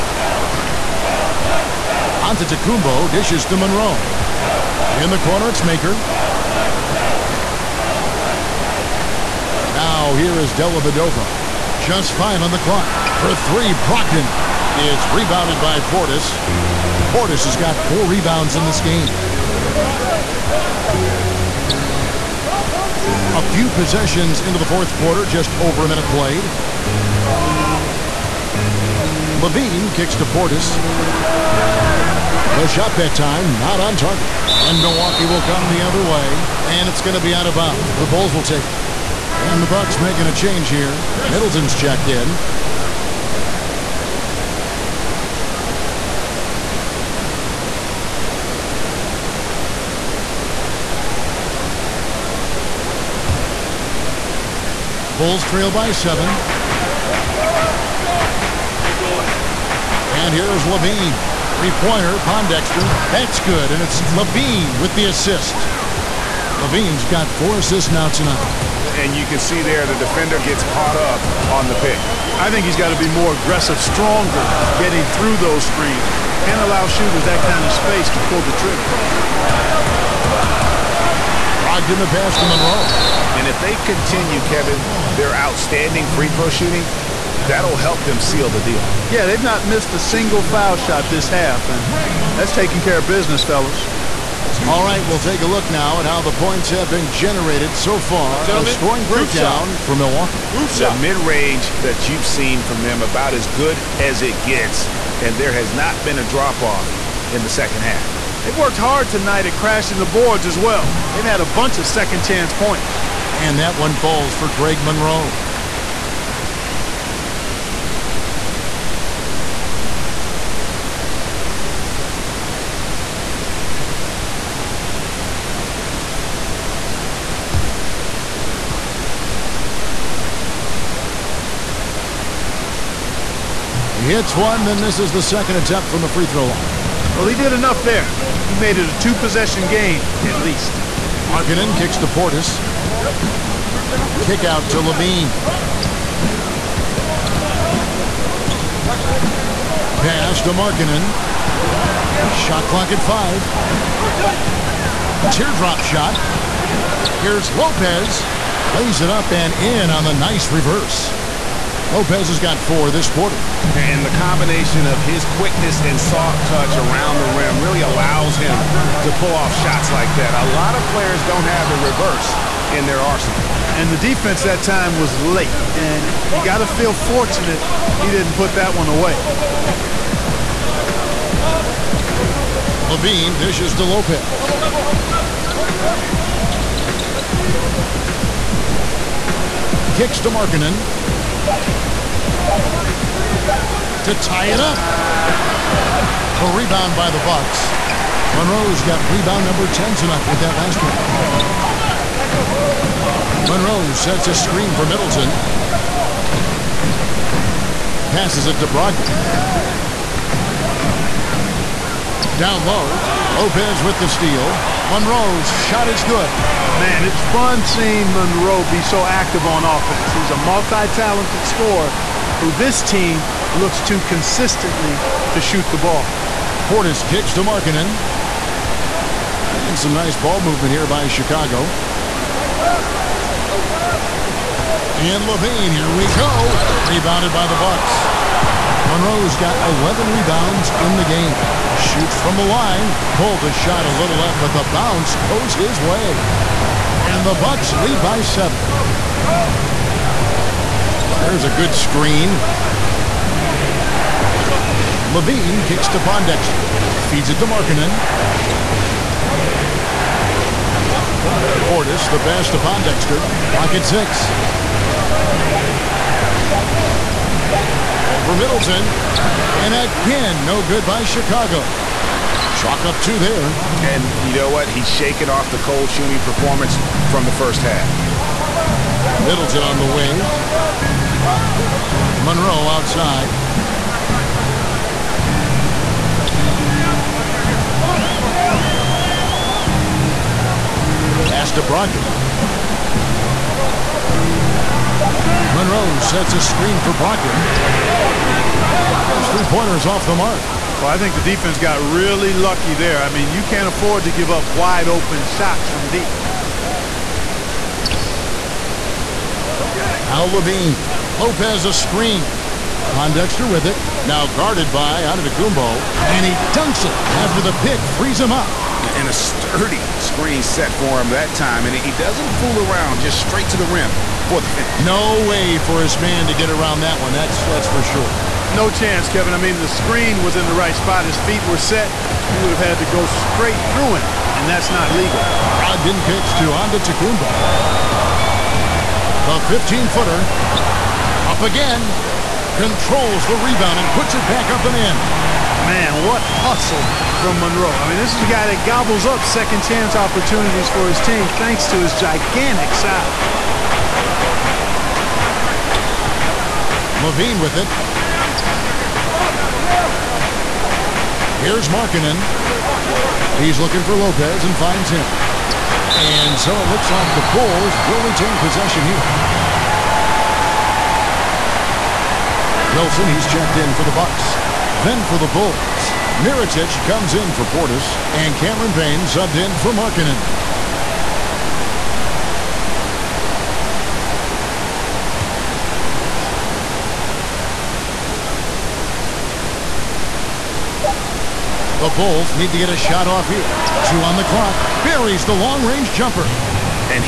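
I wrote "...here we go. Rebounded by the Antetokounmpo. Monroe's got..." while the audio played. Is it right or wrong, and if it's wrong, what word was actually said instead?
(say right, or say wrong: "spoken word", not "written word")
wrong: "Bucks", not "Antetokounmpo".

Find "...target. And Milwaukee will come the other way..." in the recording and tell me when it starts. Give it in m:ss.
0:33.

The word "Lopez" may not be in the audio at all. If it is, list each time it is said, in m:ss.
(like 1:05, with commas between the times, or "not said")
2:37, 2:41, 3:03, 3:33, 5:11, 6:03.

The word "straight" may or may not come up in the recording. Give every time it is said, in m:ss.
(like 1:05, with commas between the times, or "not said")
5:23, 5:33.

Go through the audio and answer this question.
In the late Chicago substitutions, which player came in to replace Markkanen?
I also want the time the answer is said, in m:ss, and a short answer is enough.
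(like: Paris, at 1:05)
Cameron Payne, at 6:18.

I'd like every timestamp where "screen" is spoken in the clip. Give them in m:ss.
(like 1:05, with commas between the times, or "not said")
1:15, 3:24, 4:11, 4:56, 5:11, 5:20, 5:29.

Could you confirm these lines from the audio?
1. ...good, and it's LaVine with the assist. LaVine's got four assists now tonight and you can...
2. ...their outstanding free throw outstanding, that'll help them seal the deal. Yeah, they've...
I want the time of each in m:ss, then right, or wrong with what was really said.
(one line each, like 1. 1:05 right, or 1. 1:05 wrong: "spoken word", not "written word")
1. 1:03 right
2. 1:25 wrong: "shooting", not "outstanding".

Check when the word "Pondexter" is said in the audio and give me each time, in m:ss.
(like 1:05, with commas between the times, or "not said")
1:02, 4:15, 4:22, 5:12.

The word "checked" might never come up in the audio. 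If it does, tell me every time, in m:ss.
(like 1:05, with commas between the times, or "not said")
0:41, 6:13.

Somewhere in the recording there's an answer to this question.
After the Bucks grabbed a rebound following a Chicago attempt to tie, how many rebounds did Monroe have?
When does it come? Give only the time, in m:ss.
3:19.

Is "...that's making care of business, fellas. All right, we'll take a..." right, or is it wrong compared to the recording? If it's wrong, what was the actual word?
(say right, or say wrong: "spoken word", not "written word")
wrong: "taking", not "making".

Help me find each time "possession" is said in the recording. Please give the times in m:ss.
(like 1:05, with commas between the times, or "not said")
0:23, 2:19, 6:08.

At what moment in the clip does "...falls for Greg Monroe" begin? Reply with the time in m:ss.
1:53.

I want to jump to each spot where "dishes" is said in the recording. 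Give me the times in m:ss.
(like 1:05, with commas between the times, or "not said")
0:03, 3:03.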